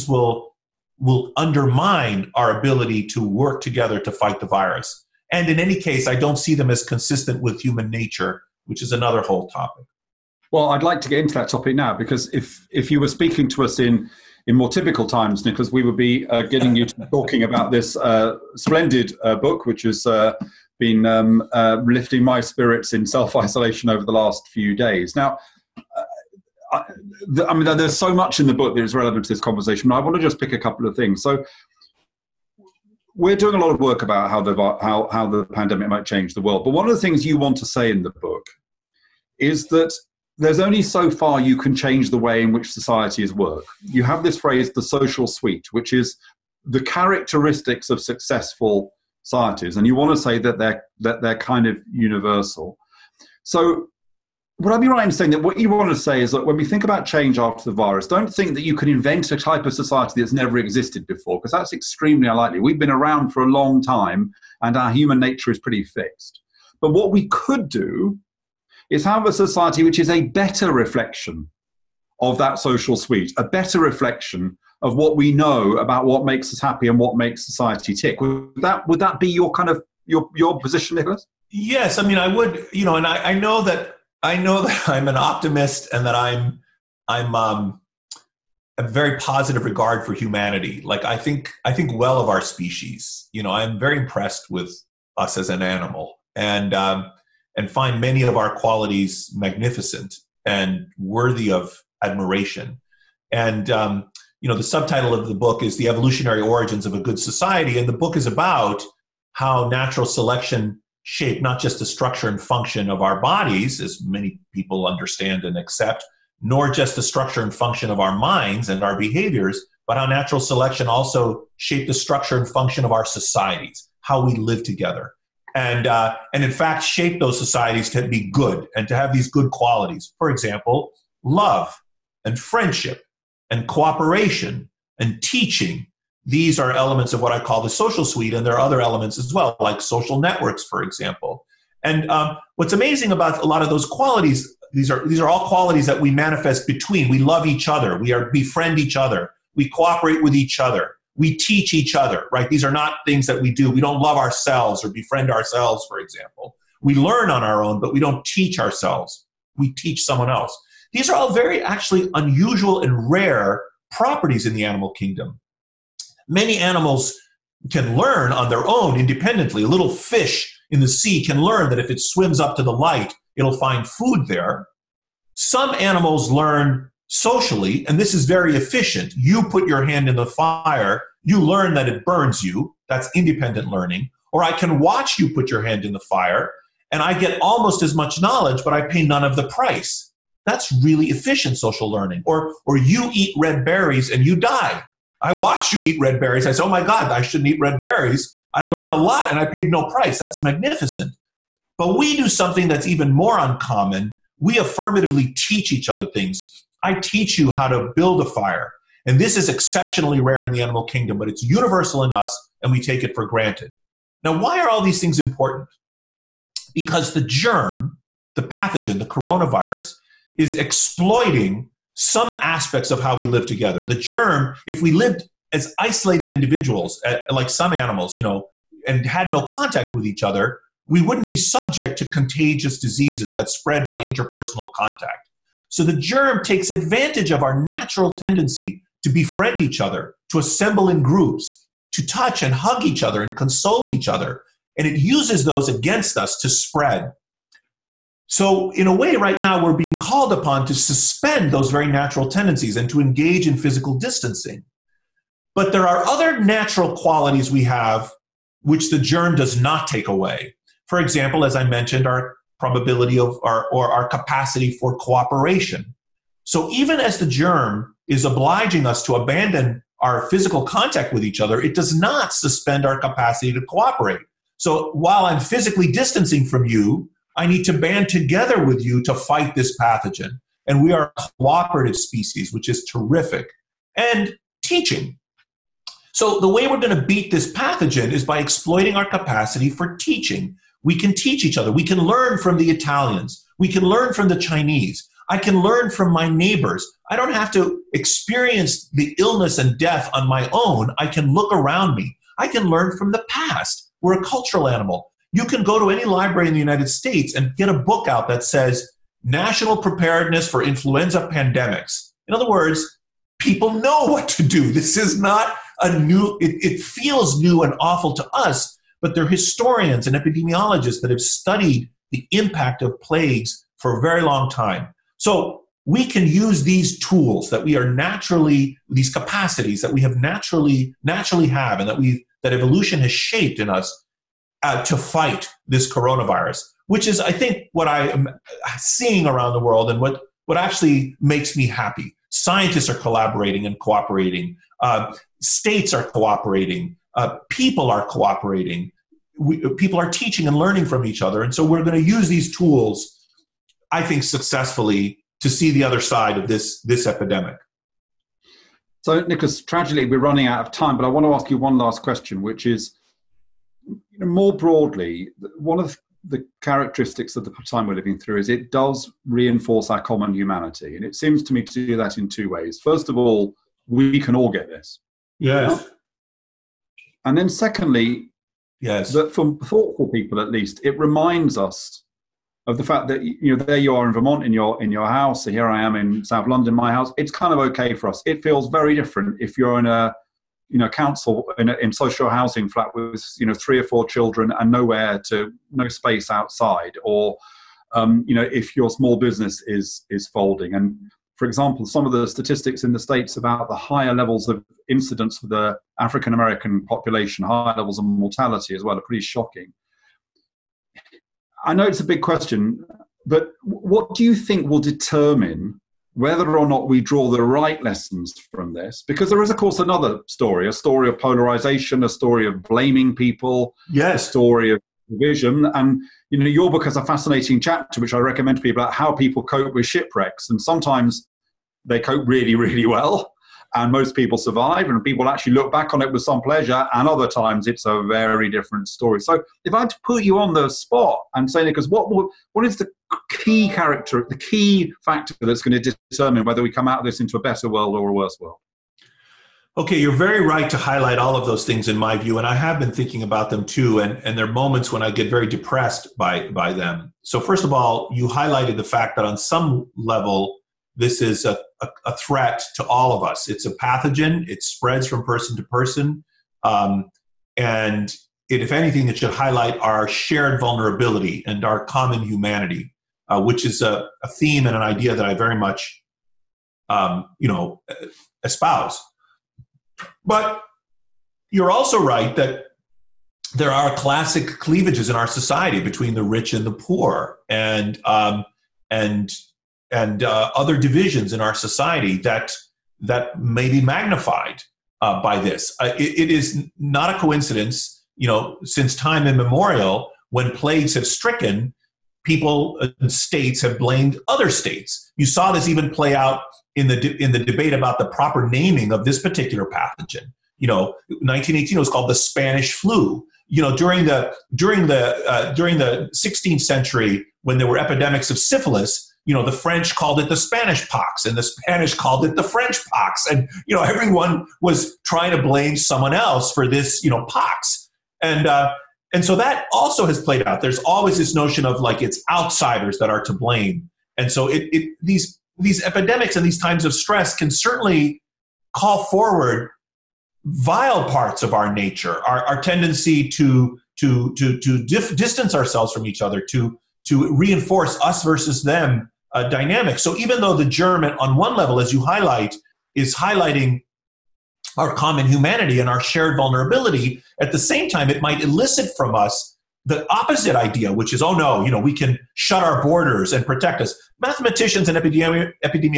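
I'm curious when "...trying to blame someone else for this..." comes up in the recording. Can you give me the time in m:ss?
8:45.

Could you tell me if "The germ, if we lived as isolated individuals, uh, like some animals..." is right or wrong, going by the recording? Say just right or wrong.
right.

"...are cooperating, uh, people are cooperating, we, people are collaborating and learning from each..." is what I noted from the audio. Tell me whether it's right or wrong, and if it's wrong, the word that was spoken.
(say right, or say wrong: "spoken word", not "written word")
wrong: "teaching", not "collaborating".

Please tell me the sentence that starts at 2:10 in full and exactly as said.
For example, love and friendship and cooperation and teaching.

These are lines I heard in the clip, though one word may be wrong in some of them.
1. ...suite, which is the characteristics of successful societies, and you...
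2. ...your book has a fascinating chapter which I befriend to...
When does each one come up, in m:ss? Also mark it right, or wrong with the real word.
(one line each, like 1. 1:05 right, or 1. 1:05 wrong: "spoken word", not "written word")
1. 0:45 right
2. 7:06 wrong: "recommend", not "befriend".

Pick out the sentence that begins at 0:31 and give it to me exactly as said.
So, we're doing a lot of work about how the how how the pandemic might change the world.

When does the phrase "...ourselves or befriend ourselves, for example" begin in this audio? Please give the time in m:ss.
2:34.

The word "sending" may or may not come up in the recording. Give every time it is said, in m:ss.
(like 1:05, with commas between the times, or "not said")
not said.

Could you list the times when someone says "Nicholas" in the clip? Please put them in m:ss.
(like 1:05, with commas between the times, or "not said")
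0:15, 1:20, 5:59, 7:21.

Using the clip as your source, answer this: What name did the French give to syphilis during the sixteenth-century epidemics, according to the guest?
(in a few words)
the Spanish pox.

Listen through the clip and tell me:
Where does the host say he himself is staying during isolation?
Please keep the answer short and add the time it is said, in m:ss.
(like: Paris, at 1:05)
South London, at 6:26.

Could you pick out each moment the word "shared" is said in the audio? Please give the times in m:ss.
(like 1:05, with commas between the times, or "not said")
7:50, 9:15.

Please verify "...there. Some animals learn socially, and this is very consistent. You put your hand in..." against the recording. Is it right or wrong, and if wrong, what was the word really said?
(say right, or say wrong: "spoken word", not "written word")
wrong: "efficient", not "consistent".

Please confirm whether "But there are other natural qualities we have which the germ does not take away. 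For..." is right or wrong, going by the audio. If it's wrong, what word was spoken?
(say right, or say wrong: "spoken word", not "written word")
right.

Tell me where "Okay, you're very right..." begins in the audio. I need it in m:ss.
7:29.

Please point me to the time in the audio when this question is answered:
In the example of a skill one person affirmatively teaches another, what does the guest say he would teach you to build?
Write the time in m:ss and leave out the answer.
3:27.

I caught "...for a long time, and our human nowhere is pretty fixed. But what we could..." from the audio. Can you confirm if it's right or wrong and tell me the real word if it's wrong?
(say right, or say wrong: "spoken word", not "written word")
wrong: "nature", not "nowhere".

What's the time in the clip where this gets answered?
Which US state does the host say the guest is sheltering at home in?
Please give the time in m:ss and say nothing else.
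6:24.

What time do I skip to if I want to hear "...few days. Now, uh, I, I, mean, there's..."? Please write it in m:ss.
0:24.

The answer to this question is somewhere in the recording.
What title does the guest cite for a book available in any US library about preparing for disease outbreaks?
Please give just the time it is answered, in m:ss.
5:09.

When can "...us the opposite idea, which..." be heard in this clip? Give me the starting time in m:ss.
9:19.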